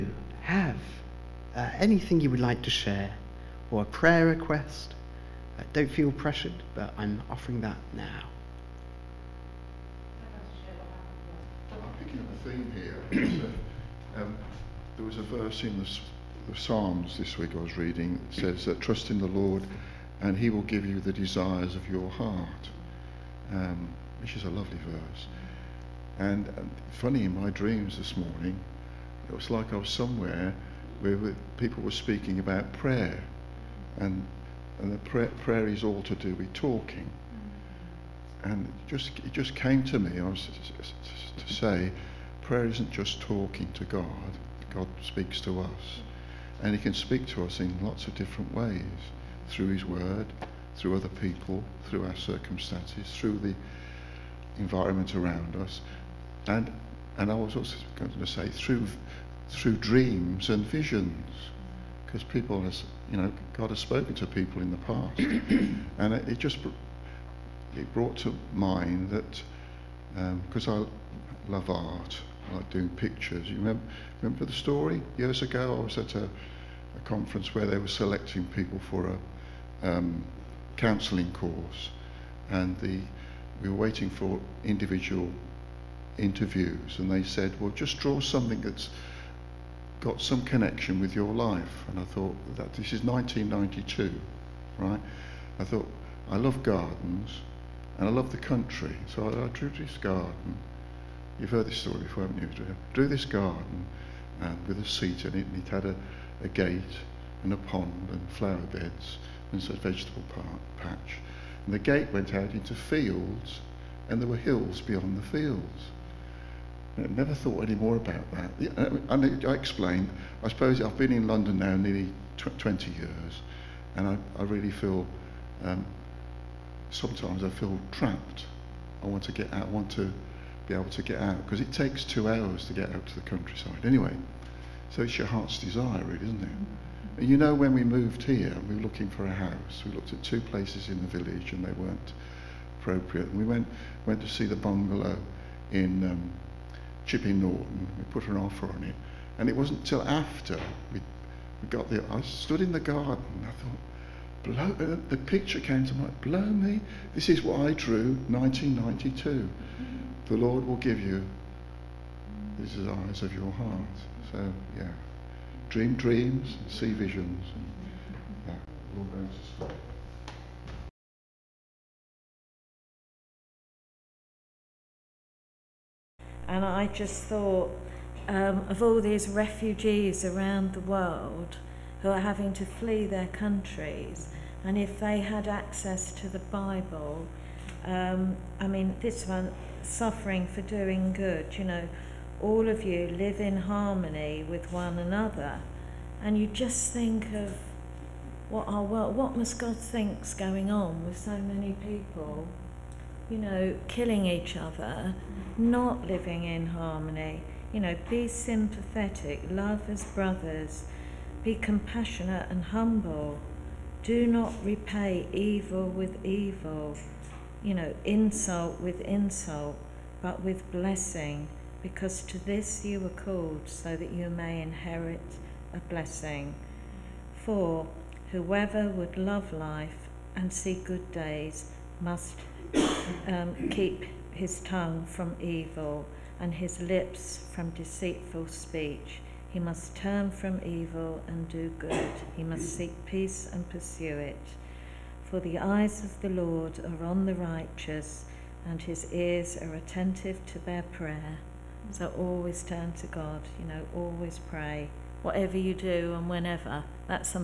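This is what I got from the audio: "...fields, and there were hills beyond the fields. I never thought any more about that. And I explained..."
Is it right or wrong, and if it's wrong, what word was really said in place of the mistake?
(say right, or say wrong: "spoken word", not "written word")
right.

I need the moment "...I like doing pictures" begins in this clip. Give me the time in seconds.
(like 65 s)
72 s.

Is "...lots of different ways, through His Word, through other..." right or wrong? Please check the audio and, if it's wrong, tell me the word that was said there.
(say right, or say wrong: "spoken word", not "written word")
right.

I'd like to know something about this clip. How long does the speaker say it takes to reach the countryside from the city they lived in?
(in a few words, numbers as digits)
2 hours.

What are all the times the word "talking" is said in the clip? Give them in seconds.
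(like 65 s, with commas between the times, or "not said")
36 s, 43 s.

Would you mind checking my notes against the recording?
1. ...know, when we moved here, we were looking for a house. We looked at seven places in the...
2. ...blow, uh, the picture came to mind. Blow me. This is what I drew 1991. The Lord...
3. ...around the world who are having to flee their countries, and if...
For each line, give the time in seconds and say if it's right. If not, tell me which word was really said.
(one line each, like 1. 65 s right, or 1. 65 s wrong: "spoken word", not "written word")
1. 137 s wrong: "two", not "seven"
2. 154 s wrong: "1992", not "1991"
3. 180 s right.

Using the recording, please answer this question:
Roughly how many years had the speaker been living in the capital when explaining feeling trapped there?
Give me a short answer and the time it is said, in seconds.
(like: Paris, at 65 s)
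20, at 122 s.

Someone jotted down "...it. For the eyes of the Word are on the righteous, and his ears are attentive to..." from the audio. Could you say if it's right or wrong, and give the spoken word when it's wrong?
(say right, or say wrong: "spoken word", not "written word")
wrong: "Lord", not "Word".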